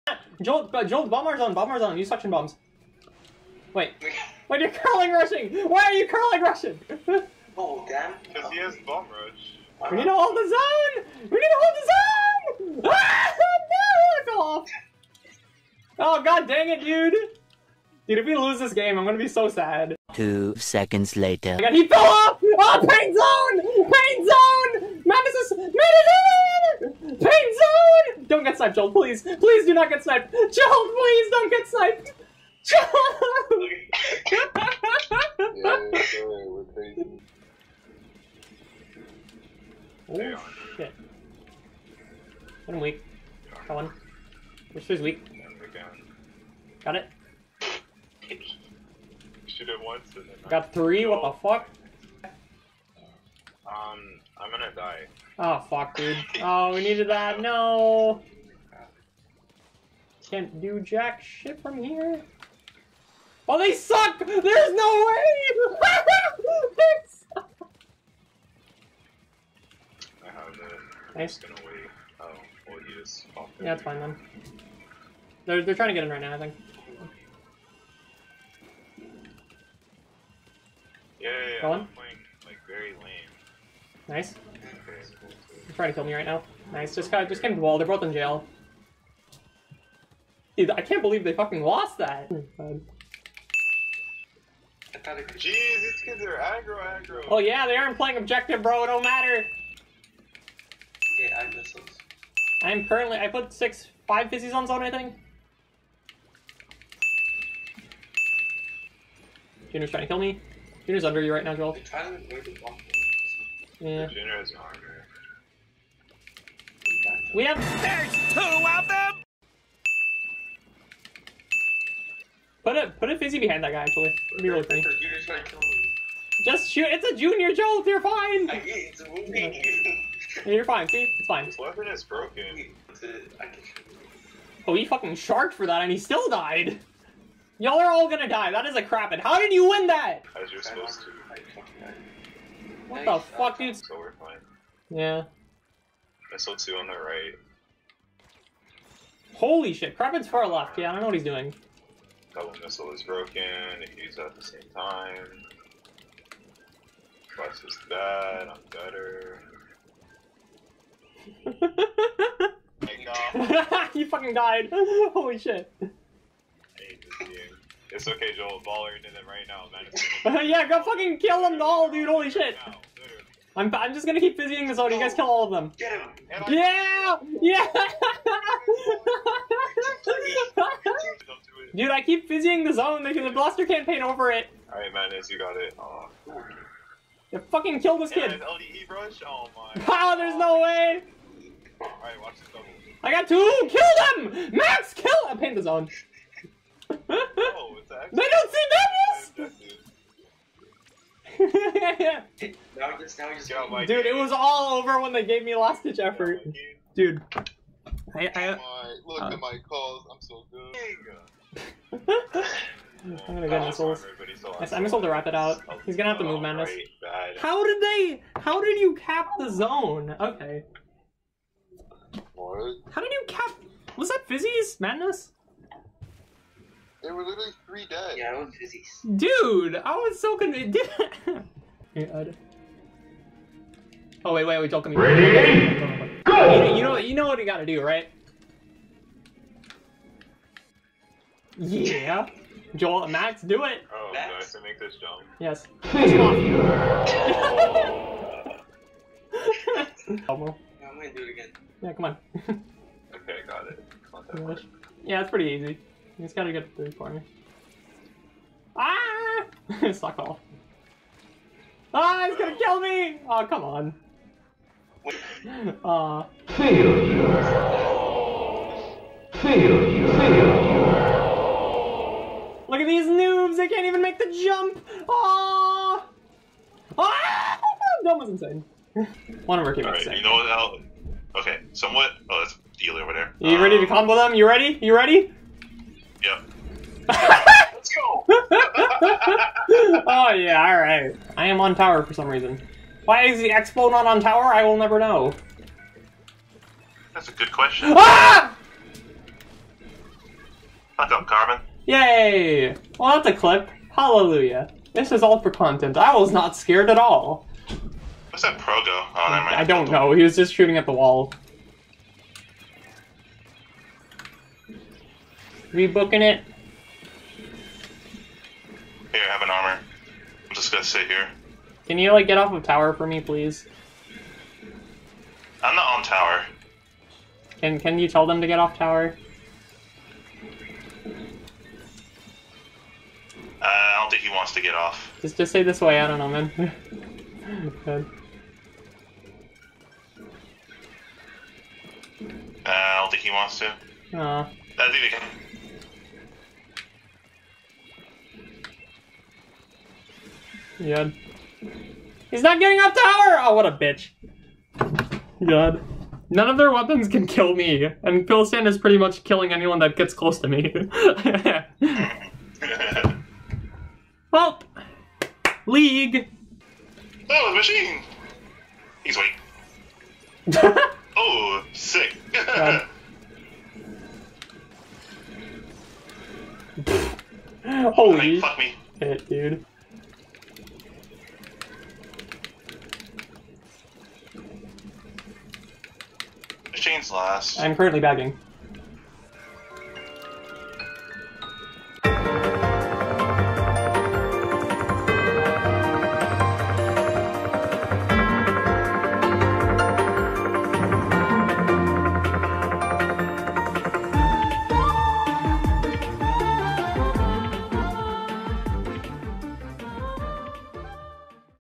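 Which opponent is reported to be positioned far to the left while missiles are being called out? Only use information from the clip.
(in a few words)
Kraven.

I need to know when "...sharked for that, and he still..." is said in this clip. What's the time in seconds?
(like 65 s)
135 s.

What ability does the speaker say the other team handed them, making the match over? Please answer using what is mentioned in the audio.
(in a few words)
last ditch effort.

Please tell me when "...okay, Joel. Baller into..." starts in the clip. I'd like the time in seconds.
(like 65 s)
168 s.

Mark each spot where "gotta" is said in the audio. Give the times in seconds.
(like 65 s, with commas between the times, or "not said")
237 s, 256 s.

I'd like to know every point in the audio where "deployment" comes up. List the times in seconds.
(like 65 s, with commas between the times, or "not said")
not said.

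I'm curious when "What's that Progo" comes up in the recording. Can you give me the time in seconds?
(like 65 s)
308 s.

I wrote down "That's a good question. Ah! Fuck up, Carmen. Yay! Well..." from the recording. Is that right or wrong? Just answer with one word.
right.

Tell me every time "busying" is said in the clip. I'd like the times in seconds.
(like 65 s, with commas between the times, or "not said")
174 s, 182 s.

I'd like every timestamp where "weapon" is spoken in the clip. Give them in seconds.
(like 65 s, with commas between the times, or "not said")
131 s, 356 s.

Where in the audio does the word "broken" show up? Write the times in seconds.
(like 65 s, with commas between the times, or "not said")
132 s, 153 s.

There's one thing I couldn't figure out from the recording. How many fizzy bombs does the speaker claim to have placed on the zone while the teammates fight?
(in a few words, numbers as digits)
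5.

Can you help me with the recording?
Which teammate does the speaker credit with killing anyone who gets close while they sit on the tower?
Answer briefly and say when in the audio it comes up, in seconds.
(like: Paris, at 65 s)
Pilsen, at 358 s.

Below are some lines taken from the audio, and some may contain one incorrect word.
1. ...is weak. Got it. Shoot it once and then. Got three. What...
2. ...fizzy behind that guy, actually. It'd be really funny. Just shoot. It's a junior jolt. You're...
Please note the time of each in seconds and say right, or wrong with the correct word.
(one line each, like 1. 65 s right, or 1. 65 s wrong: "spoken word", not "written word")
1. 44 s right
2. 123 s right.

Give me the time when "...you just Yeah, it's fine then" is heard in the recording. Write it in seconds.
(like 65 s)
72 s.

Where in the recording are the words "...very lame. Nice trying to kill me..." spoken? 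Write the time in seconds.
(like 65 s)
82 s.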